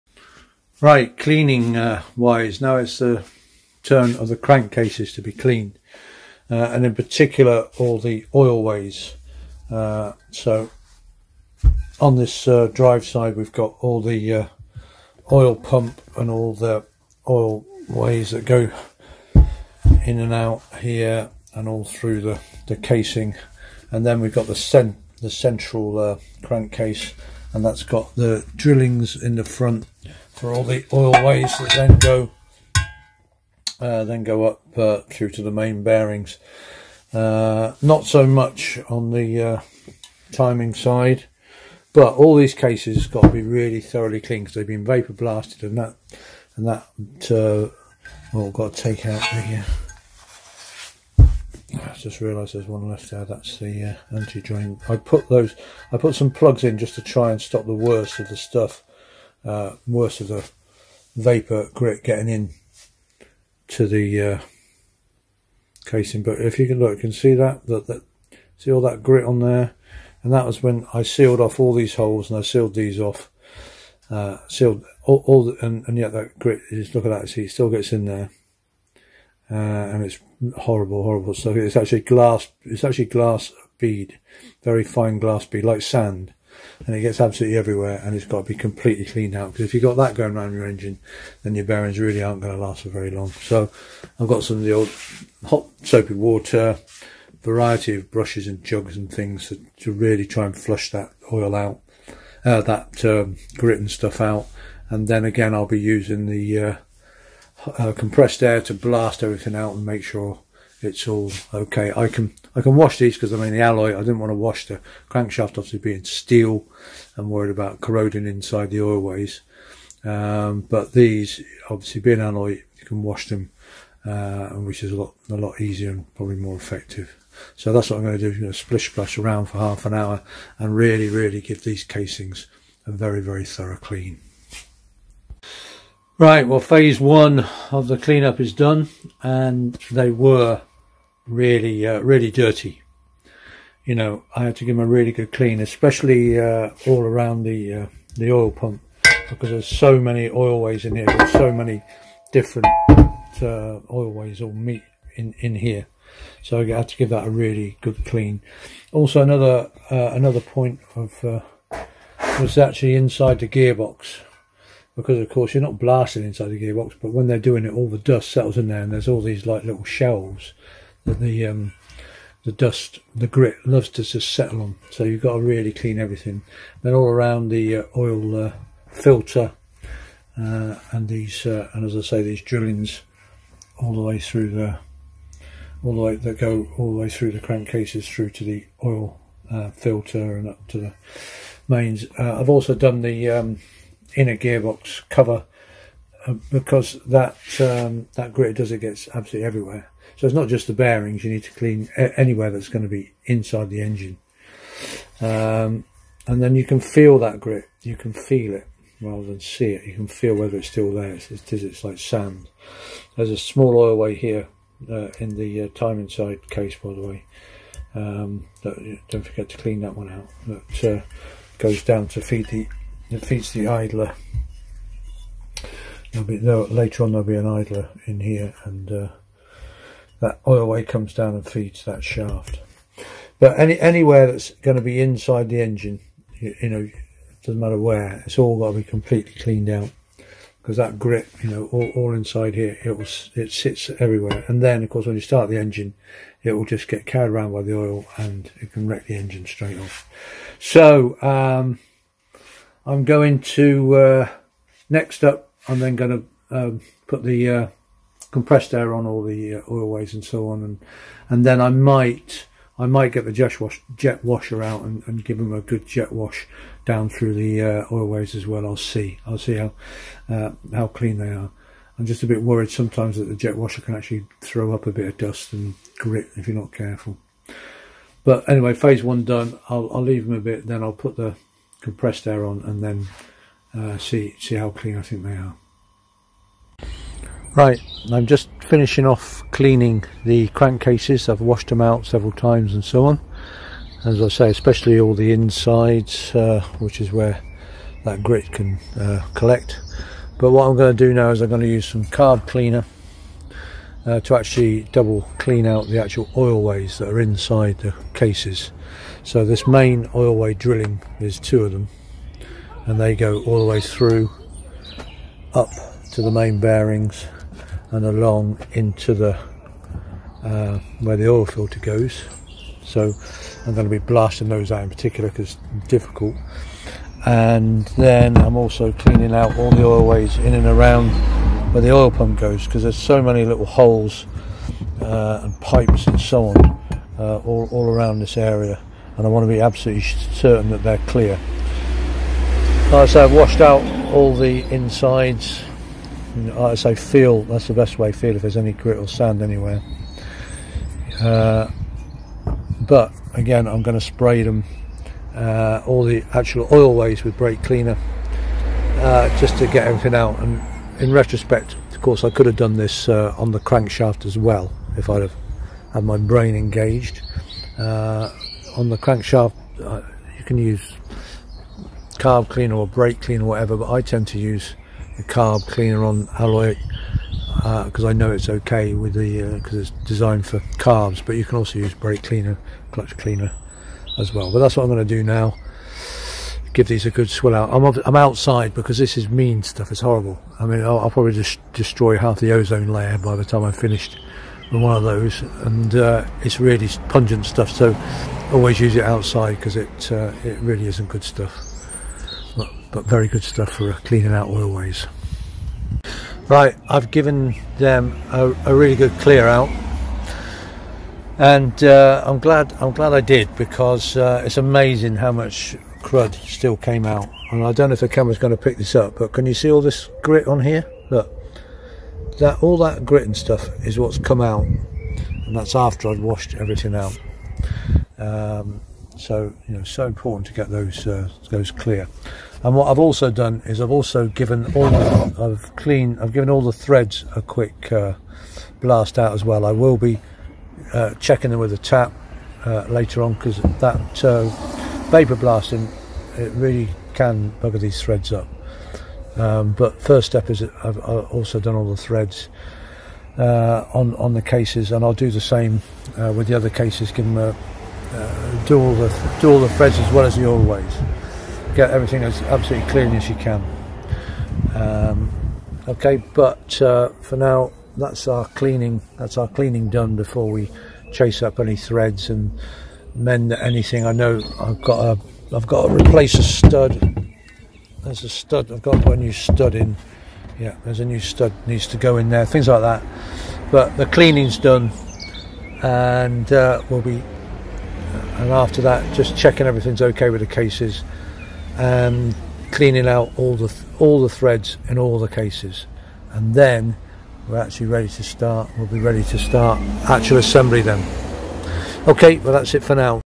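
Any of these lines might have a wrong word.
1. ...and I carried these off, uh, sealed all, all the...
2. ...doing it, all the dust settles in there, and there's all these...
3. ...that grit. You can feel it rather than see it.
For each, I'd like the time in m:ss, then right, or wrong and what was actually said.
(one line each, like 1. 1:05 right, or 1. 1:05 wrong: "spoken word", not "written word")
1. 1:12 wrong: "sealed", not "carried"
2. 2:47 right
3. 3:27 right.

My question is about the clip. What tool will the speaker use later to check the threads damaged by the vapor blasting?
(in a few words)
A tap.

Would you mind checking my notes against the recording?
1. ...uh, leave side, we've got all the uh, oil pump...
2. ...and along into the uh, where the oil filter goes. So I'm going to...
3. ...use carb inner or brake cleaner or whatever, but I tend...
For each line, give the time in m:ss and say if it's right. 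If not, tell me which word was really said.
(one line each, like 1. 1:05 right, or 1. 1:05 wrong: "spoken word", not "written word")
1. 0:12 wrong: "drive", not "leave"
2. 5:17 right
3. 6:10 wrong: "cleaner", not "inner".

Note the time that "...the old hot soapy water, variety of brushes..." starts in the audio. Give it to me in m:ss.
1:34.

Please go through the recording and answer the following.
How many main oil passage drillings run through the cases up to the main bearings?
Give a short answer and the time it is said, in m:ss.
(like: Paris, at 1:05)
2, at 5:11.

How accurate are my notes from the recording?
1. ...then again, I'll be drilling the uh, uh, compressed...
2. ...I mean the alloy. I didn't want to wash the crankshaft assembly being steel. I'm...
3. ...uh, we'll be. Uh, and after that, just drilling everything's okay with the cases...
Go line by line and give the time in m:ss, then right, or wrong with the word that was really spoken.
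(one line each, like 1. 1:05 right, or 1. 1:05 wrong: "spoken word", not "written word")
1. 1:45 wrong: "using", not "drilling"
2. 1:53 wrong: "obviously", not "assembly"
3. 8:06 wrong: "checking", not "drilling".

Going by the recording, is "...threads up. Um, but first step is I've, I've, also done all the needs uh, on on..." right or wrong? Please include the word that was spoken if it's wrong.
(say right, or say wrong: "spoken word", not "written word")
wrong: "threads", not "needs".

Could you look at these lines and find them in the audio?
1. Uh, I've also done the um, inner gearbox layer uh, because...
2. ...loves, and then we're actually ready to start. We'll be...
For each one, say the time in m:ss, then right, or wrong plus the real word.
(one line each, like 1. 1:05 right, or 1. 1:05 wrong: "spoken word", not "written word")
1. 3:12 wrong: "cover", not "layer"
2. 8:15 wrong: "cases", not "loves".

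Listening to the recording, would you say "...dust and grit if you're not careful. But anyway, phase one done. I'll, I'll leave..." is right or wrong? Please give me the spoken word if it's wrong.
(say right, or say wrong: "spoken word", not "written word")
right.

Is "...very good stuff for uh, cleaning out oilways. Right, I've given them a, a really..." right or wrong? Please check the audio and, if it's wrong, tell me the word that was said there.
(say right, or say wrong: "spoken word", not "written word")
right.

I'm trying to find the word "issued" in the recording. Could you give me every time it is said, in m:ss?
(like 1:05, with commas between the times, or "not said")
not said.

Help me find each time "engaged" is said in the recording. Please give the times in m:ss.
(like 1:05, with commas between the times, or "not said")
6:06.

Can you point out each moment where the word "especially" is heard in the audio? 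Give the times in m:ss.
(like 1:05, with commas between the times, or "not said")
2:25, 4:54.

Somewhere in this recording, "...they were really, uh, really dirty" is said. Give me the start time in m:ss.
2:19.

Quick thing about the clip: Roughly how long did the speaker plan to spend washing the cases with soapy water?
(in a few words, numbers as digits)
Half an hour.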